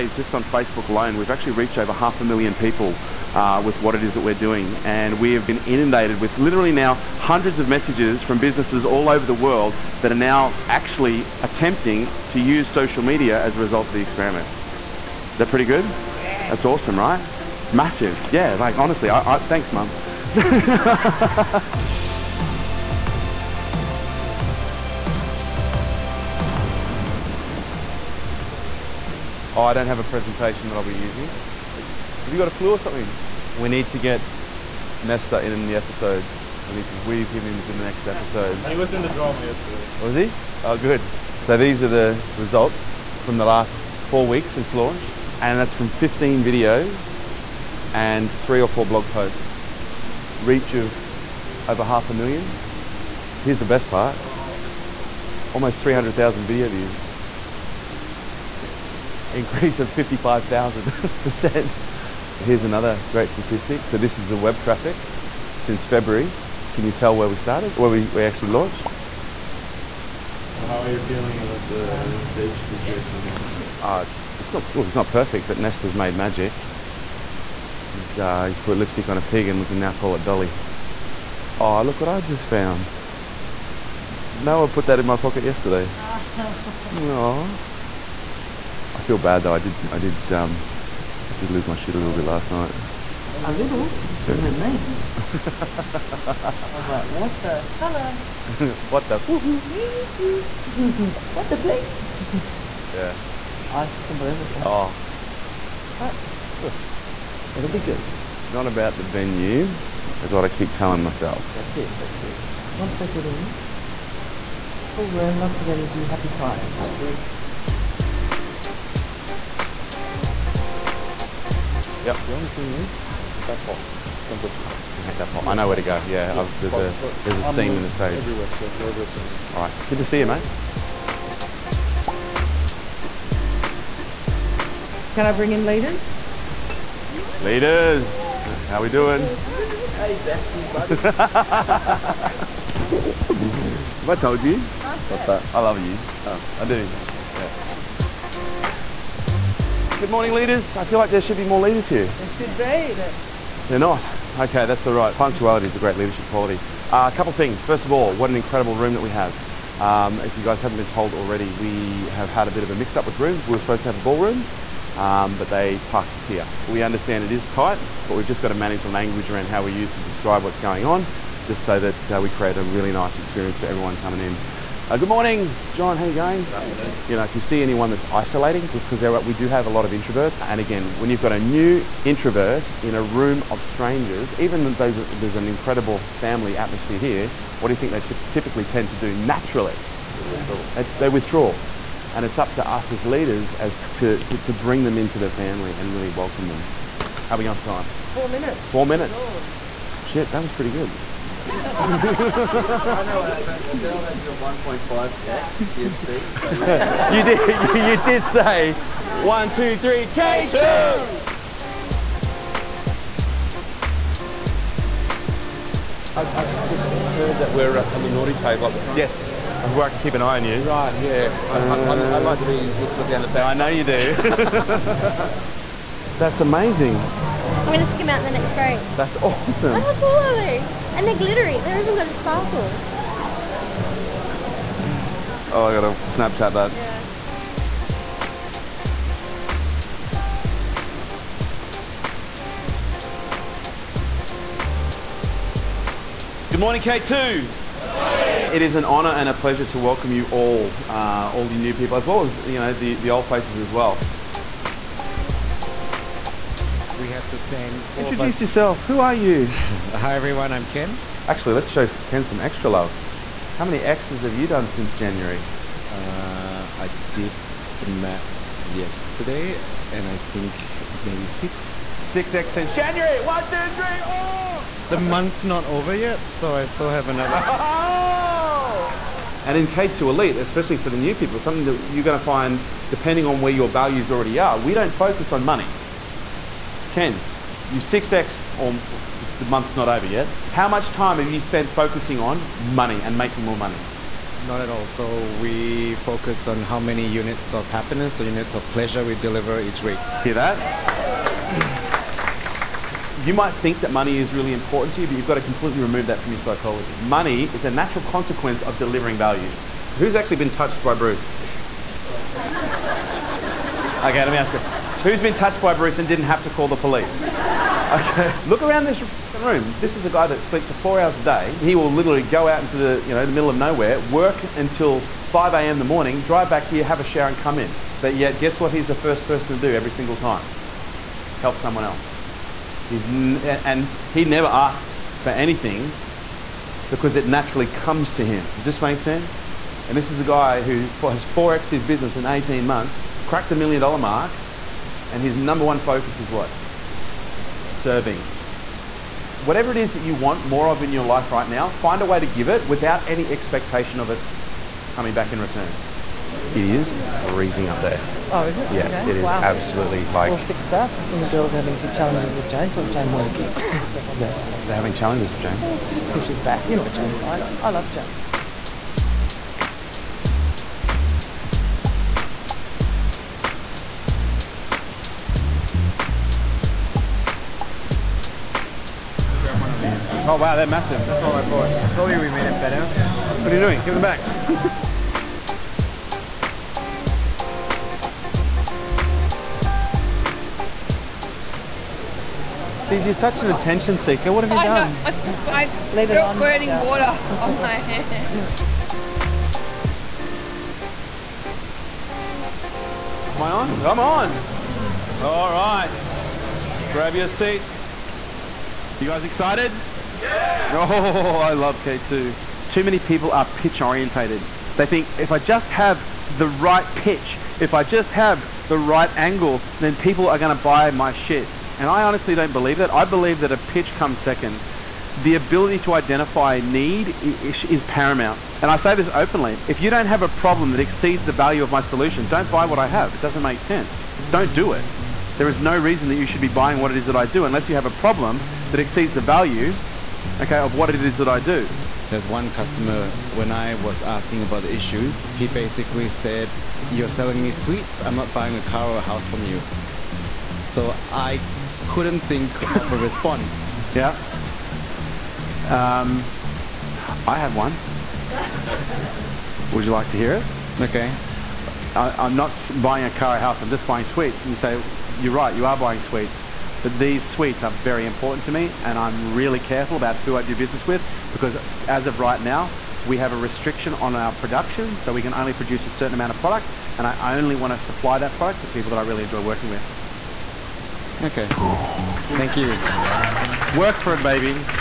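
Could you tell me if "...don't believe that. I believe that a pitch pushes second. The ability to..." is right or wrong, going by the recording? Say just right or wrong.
wrong.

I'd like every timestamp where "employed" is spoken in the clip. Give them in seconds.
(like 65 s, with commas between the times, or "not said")
not said.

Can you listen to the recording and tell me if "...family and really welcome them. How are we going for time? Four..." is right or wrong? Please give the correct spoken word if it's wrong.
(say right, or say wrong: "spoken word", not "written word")
right.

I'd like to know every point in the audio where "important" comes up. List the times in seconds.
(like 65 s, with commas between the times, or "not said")
304 s, 468 s.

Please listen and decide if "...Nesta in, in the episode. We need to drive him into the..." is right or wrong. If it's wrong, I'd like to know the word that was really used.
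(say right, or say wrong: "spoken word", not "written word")
wrong: "weave", not "drive".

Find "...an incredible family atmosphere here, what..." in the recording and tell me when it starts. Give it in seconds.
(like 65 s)
185 s.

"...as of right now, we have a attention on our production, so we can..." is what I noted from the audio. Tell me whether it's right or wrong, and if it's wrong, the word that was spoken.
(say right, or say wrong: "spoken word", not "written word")
wrong: "restriction", not "attention".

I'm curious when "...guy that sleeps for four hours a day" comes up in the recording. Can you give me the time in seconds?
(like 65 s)
320 s.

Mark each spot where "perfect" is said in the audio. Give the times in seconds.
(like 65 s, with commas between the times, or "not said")
75 s.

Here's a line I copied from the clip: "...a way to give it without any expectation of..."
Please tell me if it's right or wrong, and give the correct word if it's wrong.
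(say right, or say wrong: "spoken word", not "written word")
right.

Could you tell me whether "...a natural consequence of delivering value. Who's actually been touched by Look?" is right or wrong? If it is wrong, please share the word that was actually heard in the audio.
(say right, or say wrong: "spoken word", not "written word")
wrong: "Bruce", not "Look".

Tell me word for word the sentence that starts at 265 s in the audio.
Uh, I did the mats yesterday, and I think maybe six.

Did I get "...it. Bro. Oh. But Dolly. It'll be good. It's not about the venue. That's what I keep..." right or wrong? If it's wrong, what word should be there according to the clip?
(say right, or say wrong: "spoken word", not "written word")
wrong: "Look", not "Dolly".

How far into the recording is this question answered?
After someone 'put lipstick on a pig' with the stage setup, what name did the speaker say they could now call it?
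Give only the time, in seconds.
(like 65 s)
80 s.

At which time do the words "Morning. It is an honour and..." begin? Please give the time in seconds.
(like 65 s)
247 s.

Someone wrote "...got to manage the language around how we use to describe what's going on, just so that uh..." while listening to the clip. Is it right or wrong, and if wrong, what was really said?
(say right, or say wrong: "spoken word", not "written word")
right.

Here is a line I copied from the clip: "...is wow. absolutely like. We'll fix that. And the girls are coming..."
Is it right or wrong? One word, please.
wrong.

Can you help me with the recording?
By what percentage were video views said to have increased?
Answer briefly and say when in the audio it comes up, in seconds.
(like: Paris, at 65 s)
55,000%, at 59 s.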